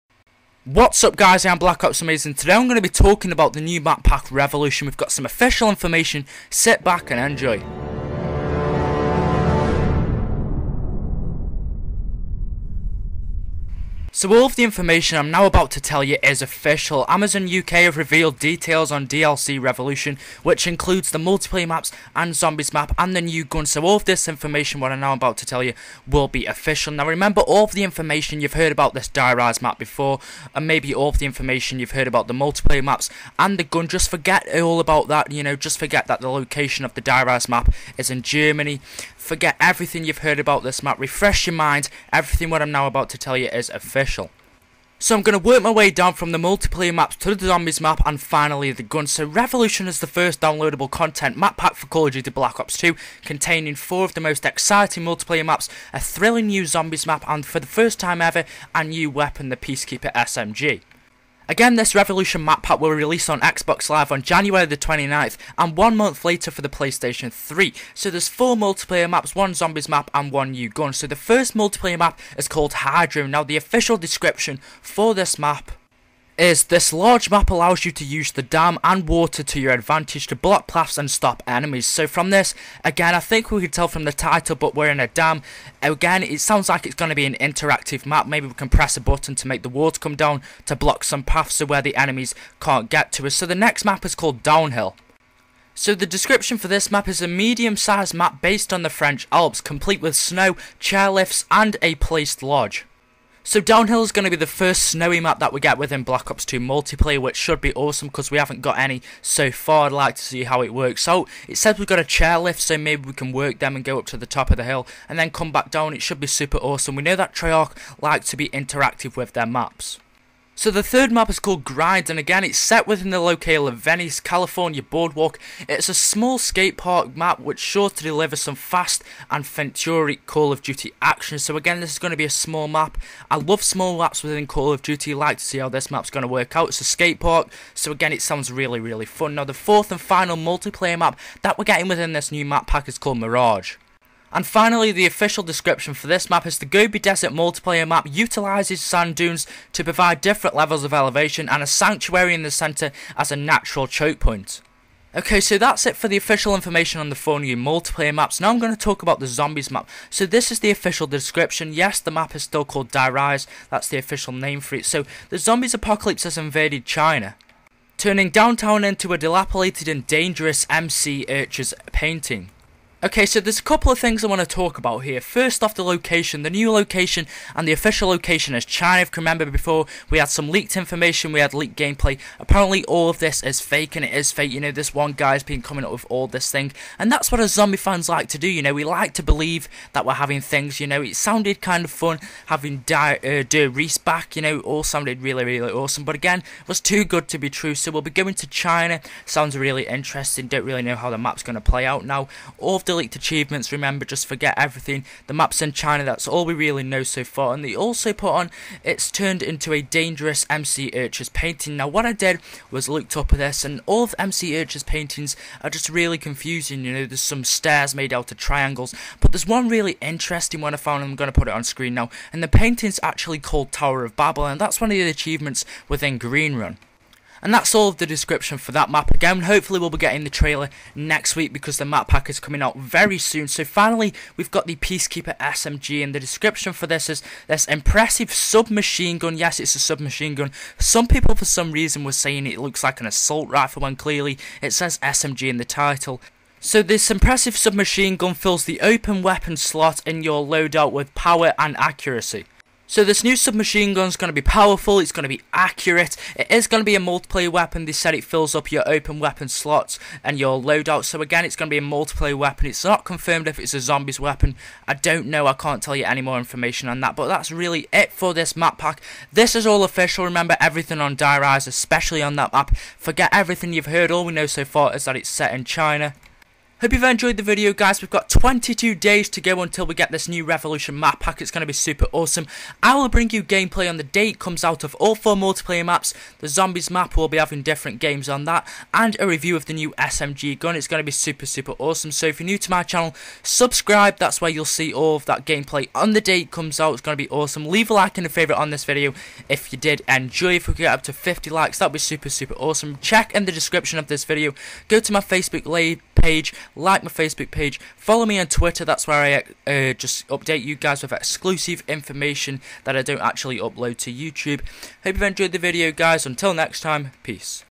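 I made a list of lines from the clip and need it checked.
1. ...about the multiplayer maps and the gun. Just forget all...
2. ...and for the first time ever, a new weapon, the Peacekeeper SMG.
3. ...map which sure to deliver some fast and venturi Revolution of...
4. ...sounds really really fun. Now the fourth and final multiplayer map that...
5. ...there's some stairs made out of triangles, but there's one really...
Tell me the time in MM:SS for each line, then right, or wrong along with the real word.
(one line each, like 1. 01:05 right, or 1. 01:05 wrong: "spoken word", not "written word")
1. 00:32 right
2. 00:57 right
3. 02:07 wrong: "Call", not "Revolution"
4. 02:18 right
5. 03:37 right.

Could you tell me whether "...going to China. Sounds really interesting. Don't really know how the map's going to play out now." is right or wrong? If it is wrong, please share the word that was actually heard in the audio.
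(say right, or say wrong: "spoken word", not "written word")
right.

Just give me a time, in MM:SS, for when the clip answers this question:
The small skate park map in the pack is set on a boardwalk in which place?
02:03.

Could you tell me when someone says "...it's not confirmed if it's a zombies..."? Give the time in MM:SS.
04:22.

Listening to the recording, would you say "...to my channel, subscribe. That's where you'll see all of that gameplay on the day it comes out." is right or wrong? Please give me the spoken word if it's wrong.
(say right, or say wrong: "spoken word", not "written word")
right.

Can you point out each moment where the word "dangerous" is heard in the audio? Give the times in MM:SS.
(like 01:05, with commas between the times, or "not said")
02:50, 03:29.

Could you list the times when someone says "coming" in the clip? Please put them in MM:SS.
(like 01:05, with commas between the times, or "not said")
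03:05, 03:52.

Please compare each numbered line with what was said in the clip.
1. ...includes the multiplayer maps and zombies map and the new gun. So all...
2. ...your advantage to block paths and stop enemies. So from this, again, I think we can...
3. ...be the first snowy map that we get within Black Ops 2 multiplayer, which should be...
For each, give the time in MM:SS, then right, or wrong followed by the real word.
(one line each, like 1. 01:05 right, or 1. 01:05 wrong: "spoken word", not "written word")
1. 00:20 right
2. 01:19 right
3. 01:44 right.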